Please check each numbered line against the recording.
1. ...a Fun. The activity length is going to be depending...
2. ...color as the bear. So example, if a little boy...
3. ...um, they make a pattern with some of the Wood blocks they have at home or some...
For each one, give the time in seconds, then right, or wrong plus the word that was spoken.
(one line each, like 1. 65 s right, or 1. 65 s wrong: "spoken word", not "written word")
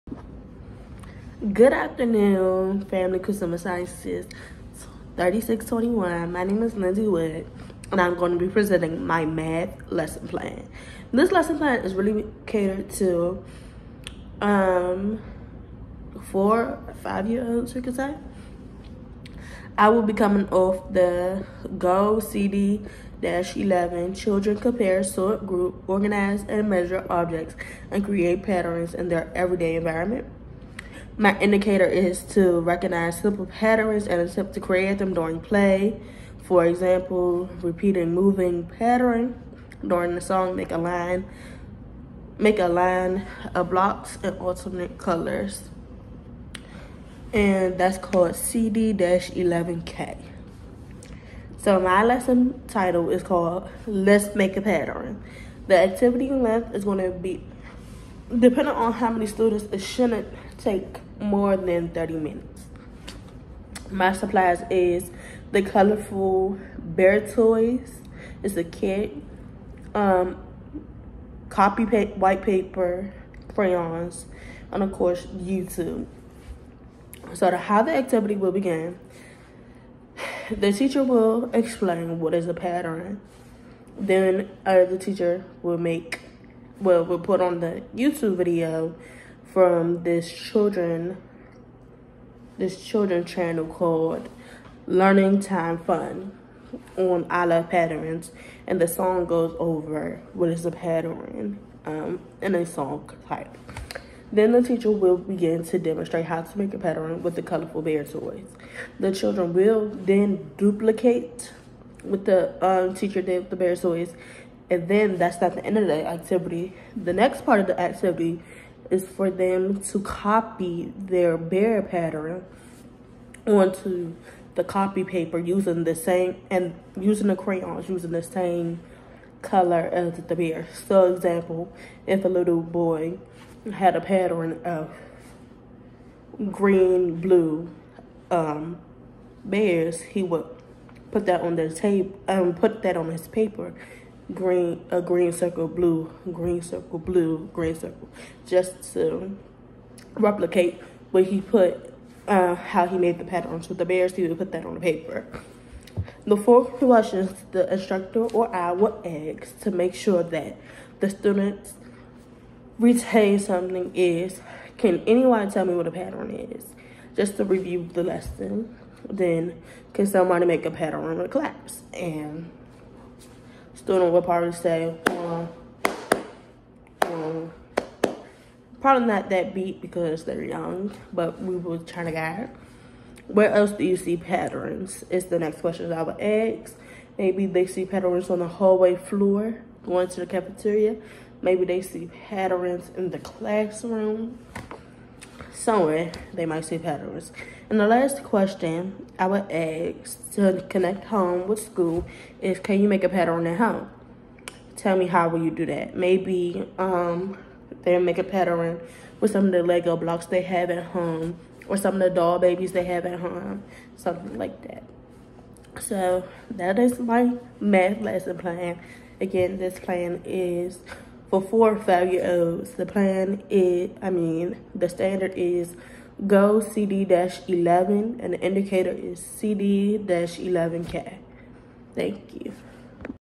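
1. 54 s wrong: "Pattern", not "Fun"
2. 129 s right
3. 206 s wrong: "Lego", not "Wood".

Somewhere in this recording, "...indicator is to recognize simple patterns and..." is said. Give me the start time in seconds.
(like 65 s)
31 s.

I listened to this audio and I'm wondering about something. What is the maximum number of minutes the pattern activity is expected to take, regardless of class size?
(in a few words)
30 minutes.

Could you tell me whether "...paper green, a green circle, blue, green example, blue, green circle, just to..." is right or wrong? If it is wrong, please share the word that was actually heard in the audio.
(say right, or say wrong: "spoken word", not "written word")
wrong: "circle", not "example".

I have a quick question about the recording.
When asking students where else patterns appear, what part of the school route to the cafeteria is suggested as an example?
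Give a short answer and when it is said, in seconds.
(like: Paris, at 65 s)
hallway floor, at 188 s.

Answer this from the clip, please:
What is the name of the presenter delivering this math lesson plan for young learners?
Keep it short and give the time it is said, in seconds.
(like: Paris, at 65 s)
Lindsay Wood, at 6 s.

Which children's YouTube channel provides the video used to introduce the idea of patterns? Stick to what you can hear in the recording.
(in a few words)
Learning Time Fun.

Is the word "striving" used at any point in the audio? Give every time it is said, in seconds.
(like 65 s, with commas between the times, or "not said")
not said.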